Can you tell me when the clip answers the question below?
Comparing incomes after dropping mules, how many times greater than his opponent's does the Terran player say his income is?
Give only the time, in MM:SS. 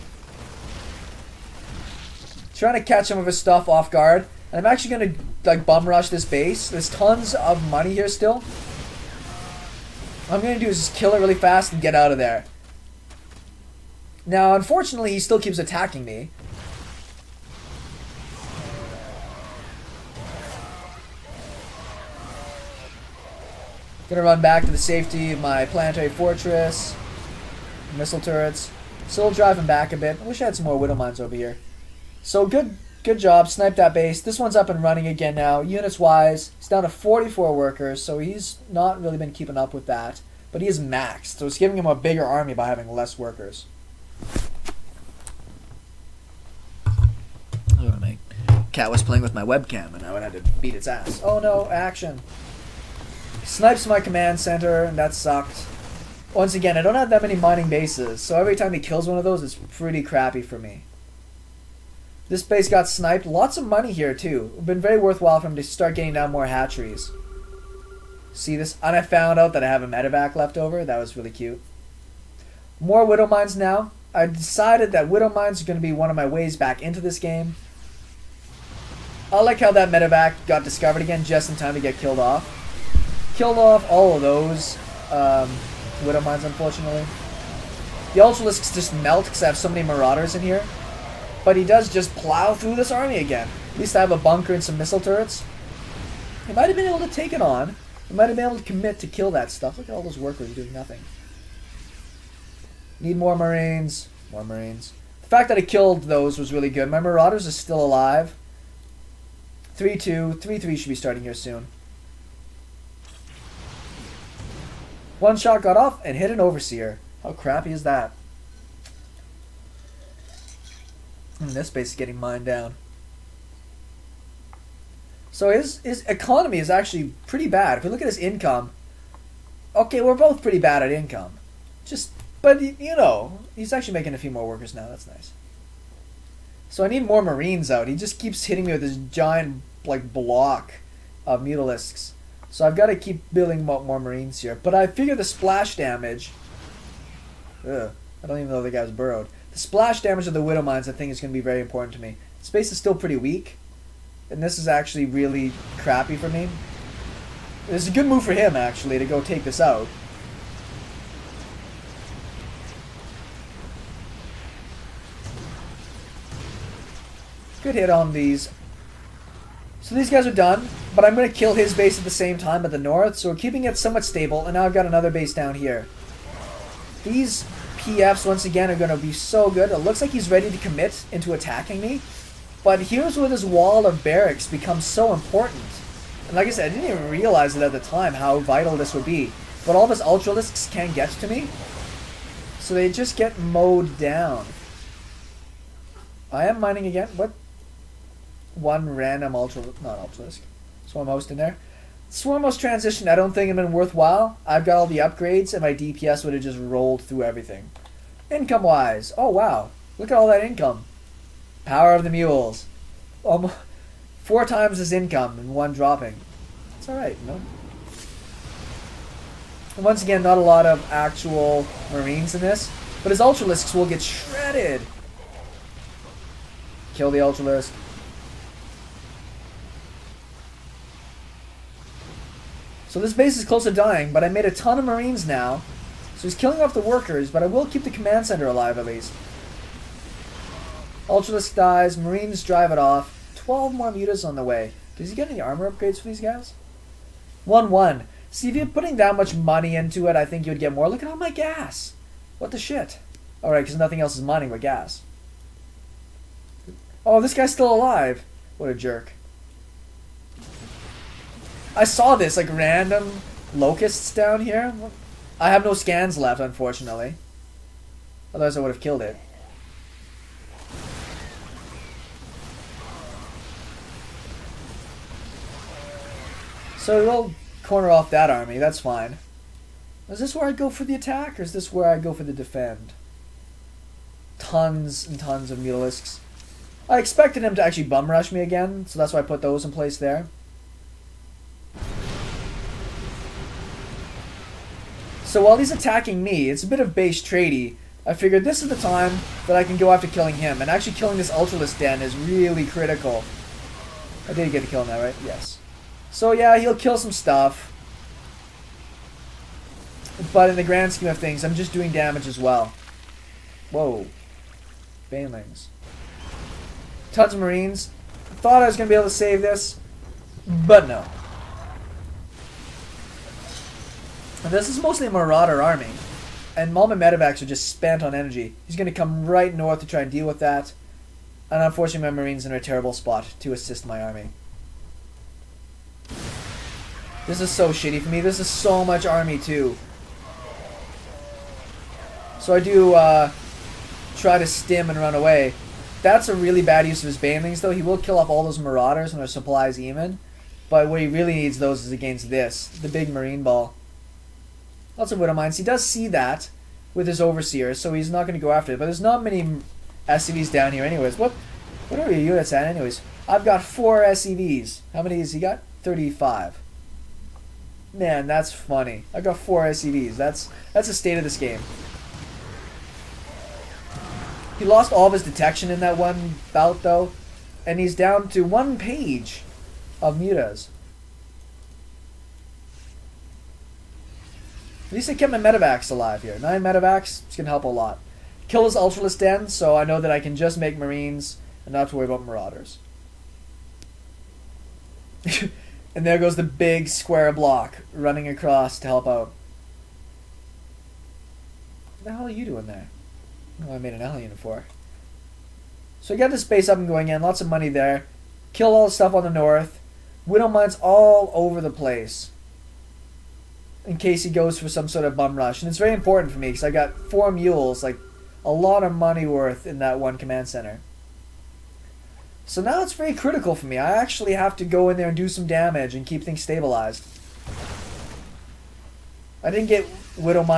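03:34.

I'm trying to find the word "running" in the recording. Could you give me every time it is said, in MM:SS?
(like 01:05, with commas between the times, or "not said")
00:34, 06:37.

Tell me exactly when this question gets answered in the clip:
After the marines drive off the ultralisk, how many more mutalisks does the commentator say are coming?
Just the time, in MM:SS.
04:03.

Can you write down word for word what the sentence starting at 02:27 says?
Ugh, I don't even know the guy's burrowed.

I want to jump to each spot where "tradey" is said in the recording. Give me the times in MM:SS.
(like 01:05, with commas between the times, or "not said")
04:57.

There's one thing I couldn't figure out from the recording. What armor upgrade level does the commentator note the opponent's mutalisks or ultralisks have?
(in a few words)
1-1.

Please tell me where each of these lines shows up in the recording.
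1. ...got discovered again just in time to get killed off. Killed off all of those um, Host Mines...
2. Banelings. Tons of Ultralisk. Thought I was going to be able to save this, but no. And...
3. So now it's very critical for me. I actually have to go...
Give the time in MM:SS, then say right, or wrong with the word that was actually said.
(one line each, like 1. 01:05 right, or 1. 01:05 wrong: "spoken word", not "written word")
1. 01:20 wrong: "Widow", not "Host"
2. 05:15 wrong: "Marines", not "Ultralisk"
3. 07:02 right.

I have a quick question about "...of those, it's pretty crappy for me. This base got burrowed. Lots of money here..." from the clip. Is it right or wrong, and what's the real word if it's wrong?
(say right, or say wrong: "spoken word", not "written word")
wrong: "sniped", not "burrowed".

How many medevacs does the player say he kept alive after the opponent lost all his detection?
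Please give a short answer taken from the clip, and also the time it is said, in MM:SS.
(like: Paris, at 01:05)
9, at 06:26.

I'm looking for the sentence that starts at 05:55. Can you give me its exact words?
He does see that with his Overseer, so he's not going to go after it.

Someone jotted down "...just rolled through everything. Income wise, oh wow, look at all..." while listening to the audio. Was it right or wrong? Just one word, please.
right.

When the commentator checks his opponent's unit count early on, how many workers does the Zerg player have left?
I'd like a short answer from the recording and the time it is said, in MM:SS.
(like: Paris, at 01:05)
44, at 00:36.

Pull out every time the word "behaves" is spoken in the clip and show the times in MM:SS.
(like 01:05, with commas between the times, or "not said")
not said.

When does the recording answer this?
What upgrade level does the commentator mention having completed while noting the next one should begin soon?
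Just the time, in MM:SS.
01:49.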